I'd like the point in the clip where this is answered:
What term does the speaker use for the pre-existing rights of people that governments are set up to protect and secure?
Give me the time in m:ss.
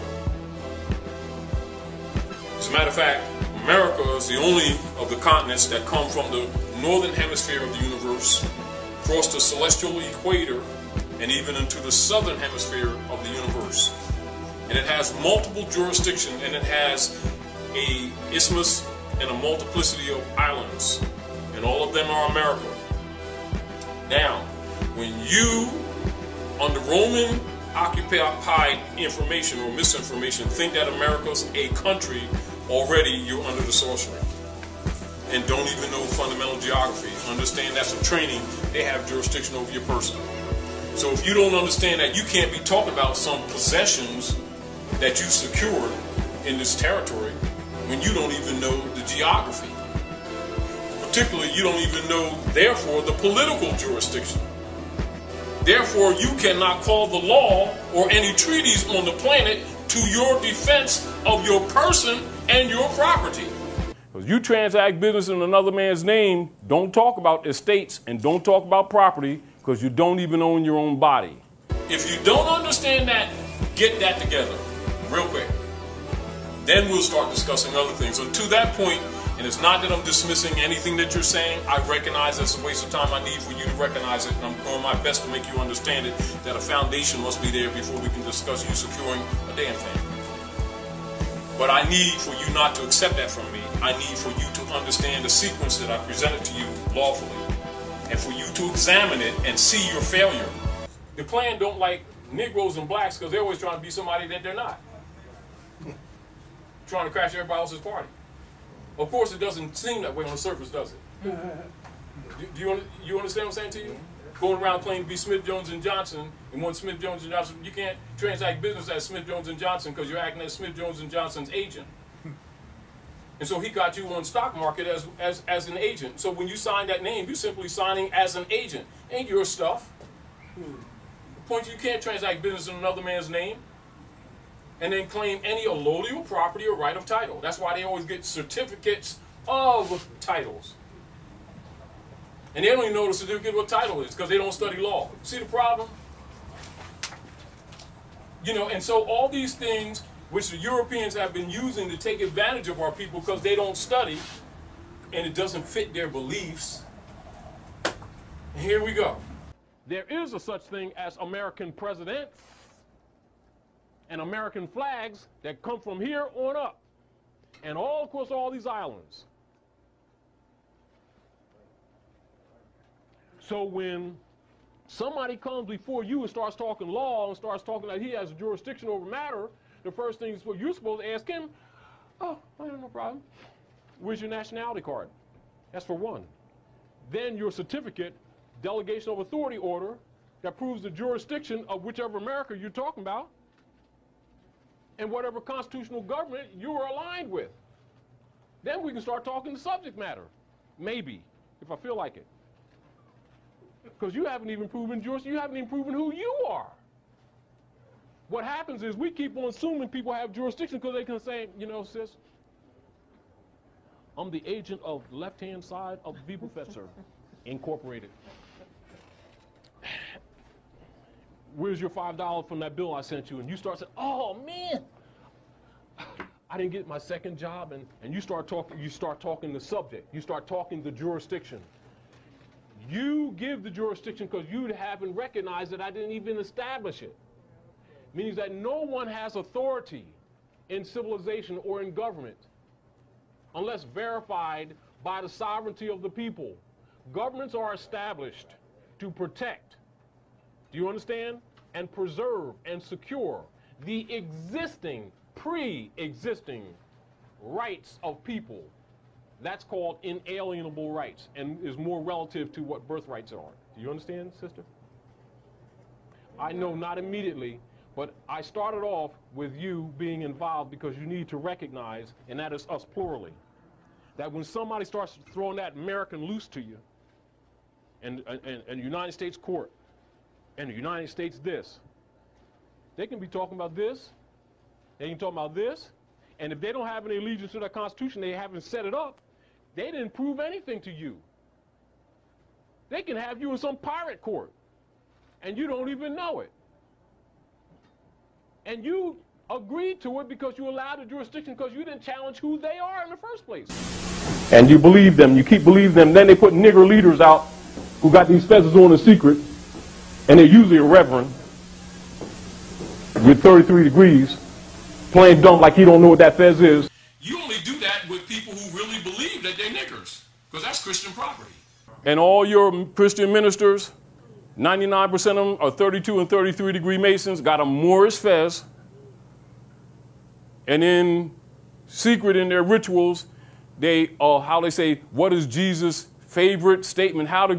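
4:20.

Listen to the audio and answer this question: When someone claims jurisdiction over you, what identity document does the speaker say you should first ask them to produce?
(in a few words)
nationality card.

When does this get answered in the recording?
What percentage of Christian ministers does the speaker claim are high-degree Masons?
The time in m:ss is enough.
5:24.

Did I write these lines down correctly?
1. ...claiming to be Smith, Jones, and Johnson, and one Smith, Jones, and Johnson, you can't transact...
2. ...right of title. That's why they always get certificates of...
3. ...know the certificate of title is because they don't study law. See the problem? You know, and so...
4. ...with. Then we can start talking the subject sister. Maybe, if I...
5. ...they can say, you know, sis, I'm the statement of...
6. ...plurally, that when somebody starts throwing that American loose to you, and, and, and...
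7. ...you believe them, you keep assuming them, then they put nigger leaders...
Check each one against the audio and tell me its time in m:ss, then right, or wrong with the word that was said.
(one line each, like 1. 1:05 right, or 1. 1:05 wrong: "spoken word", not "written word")
1. 1:54 right
2. 2:16 right
3. 2:22 right
4. 3:17 wrong: "matter", not "sister"
5. 3:30 wrong: "agent", not "statement"
6. 4:32 right
7. 5:04 wrong: "believing", not "assuming".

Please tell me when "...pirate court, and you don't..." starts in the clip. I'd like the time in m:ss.
4:53.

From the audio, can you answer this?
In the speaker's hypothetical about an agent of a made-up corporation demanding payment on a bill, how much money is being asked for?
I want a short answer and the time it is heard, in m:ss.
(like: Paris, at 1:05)
$5, at 3:41.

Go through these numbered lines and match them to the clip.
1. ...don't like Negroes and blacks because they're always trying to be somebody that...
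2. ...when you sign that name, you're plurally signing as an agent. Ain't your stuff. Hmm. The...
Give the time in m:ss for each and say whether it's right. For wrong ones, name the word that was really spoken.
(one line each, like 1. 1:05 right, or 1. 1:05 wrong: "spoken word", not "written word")
1. 1:41 right
2. 2:06 wrong: "simply", not "plurally".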